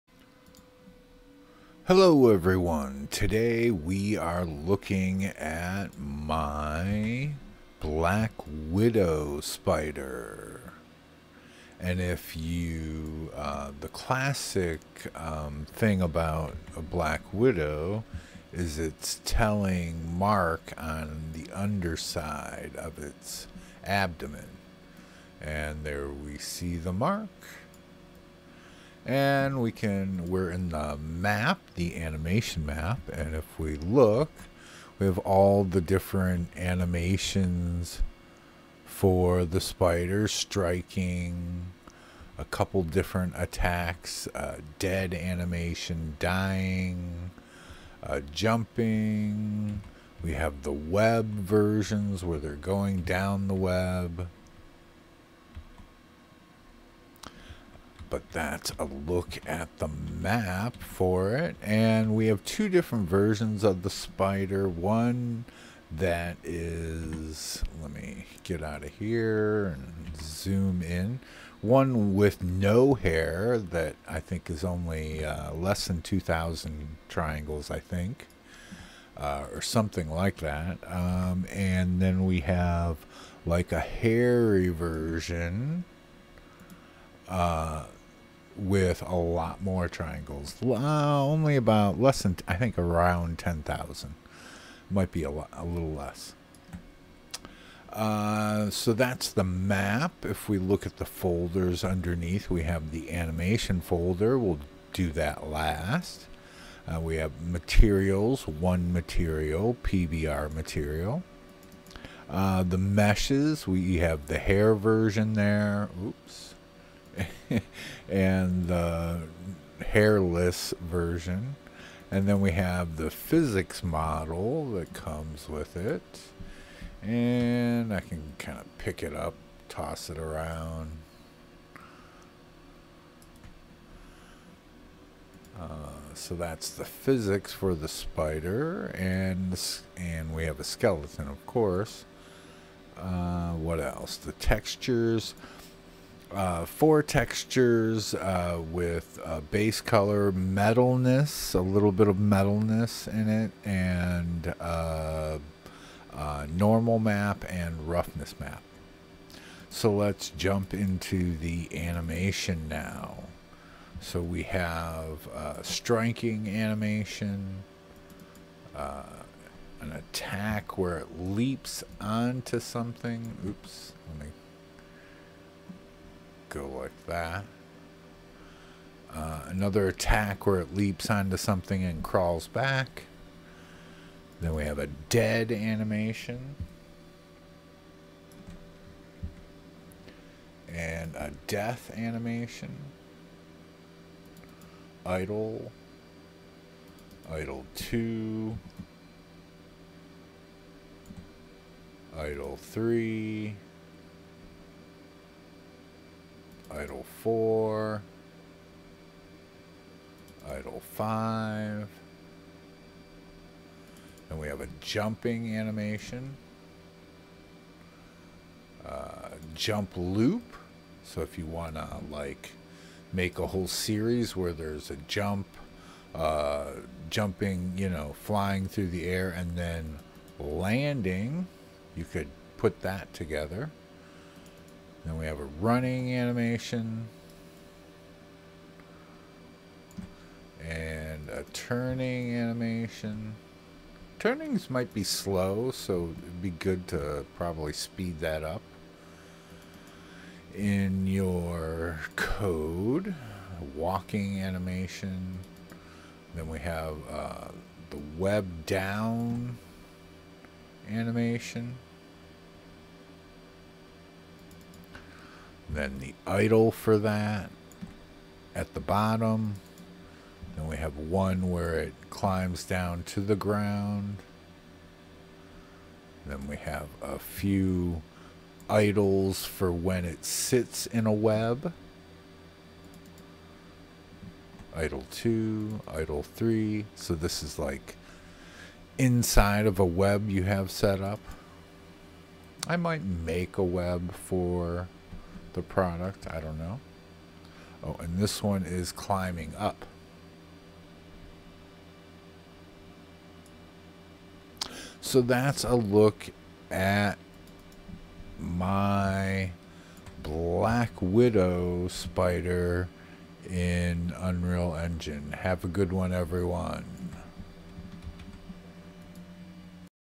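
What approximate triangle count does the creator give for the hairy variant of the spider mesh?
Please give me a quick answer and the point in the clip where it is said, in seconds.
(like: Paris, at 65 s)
around 10,000, at 92 s.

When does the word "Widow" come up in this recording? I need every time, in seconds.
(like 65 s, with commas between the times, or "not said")
8 s, 17 s, 311 s.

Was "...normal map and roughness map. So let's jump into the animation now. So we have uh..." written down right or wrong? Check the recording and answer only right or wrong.
right.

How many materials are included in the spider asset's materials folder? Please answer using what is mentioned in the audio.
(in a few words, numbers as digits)
1.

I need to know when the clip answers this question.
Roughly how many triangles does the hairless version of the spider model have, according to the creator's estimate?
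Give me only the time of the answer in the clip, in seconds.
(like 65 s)
75 s.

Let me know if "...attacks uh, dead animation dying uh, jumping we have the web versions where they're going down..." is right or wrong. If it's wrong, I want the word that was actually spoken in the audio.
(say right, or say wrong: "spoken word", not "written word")
right.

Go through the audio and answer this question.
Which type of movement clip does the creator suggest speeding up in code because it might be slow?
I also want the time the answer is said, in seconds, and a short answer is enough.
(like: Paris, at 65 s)
turning animation, at 241 s.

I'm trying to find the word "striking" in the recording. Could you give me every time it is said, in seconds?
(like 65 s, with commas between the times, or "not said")
40 s, 165 s.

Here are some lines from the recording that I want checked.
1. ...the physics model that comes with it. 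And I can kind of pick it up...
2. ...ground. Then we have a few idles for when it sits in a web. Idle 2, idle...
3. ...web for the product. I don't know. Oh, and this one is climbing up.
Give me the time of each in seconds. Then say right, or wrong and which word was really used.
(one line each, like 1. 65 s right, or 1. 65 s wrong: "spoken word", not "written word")
1. 122 s right
2. 273 s right
3. 293 s right.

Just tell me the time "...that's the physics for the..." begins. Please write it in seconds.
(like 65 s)
136 s.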